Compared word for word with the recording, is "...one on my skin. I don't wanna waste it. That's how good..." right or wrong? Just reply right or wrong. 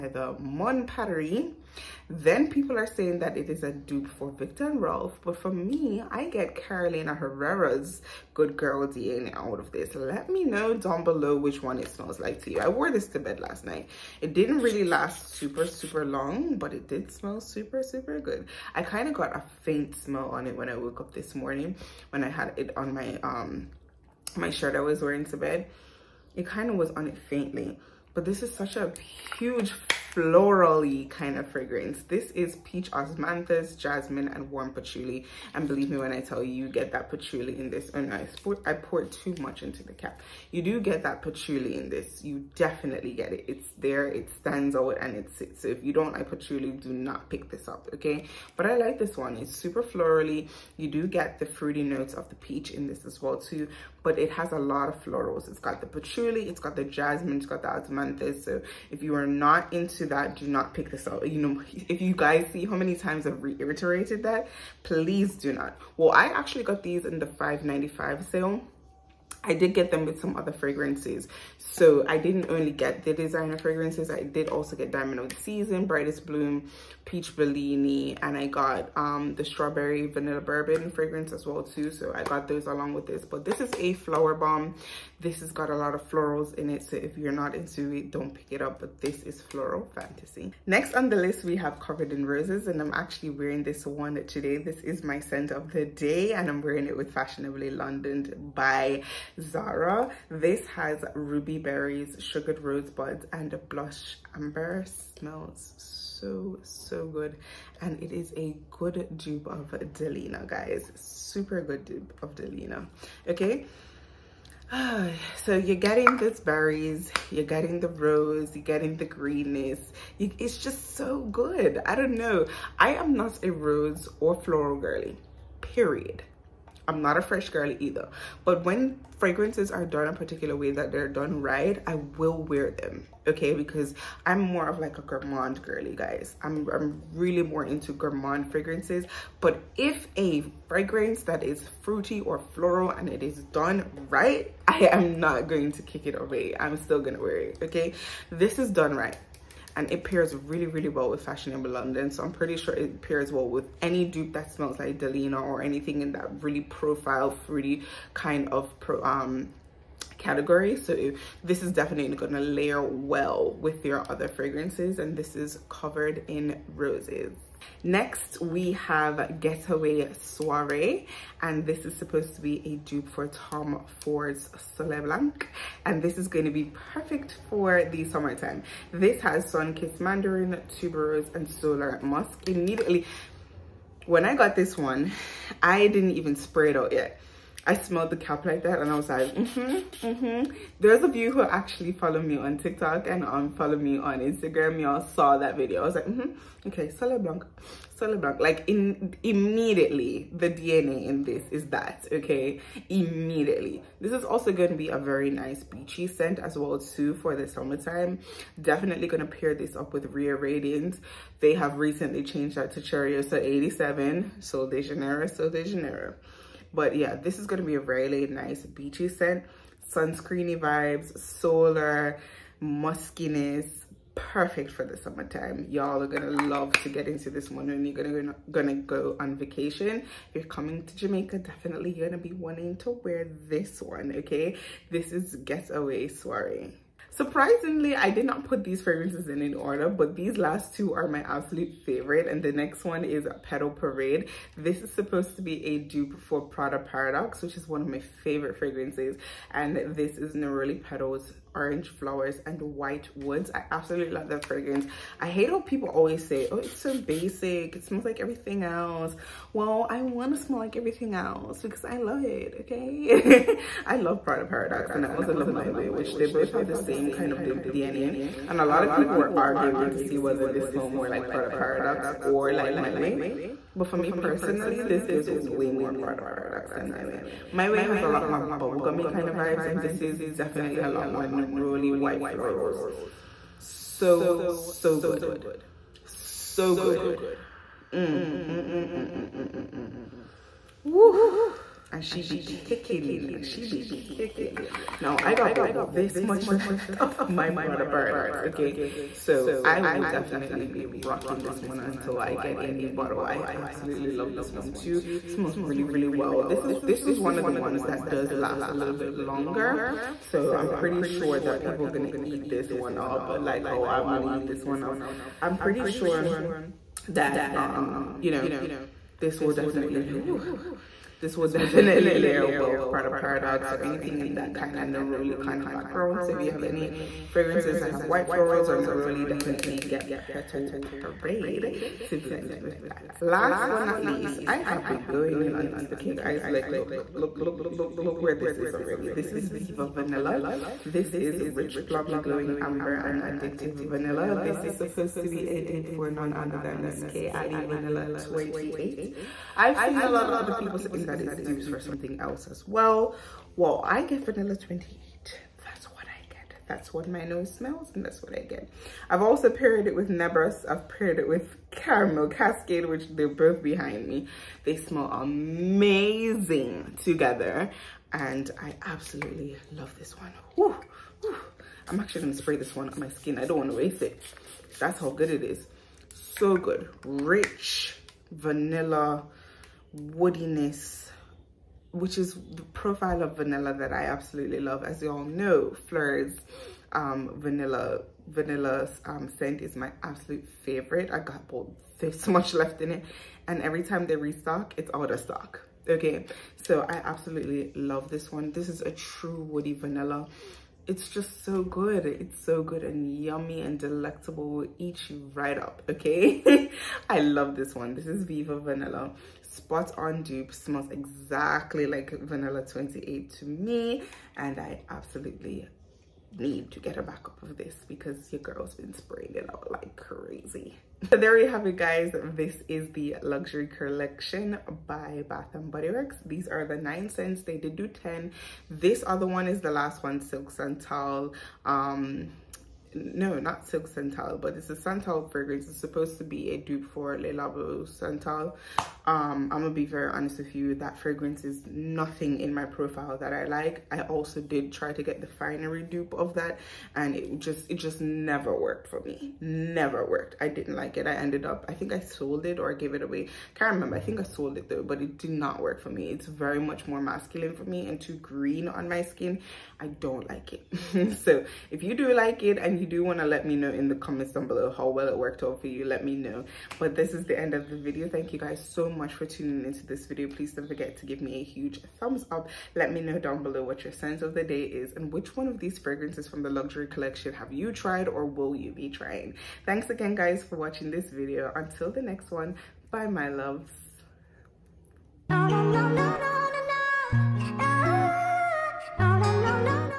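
right.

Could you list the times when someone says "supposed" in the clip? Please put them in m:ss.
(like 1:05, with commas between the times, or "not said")
2:51, 4:04, 5:44, 7:15.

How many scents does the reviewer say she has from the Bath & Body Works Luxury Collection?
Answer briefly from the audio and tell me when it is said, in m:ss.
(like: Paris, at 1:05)
9, at 7:06.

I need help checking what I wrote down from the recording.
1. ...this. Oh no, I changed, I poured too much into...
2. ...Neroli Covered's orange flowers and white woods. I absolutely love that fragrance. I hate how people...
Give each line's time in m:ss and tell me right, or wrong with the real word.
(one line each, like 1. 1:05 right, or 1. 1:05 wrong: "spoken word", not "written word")
1. 0:37 wrong: "poured", not "changed"
2. 4:10 wrong: "Petal", not "Covered".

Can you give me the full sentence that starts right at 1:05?
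Well, I actually got these in the 5.95 sale I did get them with some other fragrances.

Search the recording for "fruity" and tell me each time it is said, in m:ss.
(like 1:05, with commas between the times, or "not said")
0:51, 2:21, 2:37.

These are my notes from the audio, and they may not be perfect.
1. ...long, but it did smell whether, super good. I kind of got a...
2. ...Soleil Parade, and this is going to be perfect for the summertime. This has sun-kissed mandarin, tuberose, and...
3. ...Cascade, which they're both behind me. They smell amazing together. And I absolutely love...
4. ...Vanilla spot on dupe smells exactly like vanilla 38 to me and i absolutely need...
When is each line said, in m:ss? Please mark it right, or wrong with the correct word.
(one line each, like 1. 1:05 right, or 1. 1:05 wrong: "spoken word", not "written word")
1. 0:16 wrong: "super", not "whether"
2. 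2:54 wrong: "Blanc", not "Parade"
3. 6:02 right
4. 6:48 wrong: "28", not "38".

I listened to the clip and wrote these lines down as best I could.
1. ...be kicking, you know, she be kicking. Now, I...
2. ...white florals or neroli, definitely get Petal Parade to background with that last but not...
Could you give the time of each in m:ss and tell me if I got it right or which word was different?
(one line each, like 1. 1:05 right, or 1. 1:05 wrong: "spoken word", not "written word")
1. 4:52 right
2. 5:28 wrong: "blend", not "background".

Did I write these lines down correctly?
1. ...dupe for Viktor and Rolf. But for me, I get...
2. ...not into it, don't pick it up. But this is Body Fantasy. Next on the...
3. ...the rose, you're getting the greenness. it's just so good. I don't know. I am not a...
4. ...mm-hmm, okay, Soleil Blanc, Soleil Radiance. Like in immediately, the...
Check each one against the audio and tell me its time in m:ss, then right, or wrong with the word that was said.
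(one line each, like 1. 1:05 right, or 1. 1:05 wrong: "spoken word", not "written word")
1. 0:03 right
2. 1:27 wrong: "Floral", not "Body"
3. 1:57 right
4. 3:16 wrong: "Blanc", not "Radiance".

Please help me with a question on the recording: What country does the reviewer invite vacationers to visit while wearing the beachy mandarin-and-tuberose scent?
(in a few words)
Jamaica.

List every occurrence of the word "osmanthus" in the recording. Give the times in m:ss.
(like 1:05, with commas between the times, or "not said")
0:32, 0:57.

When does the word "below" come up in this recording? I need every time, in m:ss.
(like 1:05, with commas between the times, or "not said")
0:11, 7:44, 7:53.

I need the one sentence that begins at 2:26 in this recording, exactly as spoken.
I'm still gonna wear it, okay?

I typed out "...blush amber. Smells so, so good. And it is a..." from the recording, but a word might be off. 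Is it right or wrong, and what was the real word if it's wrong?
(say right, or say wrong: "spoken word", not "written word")
right.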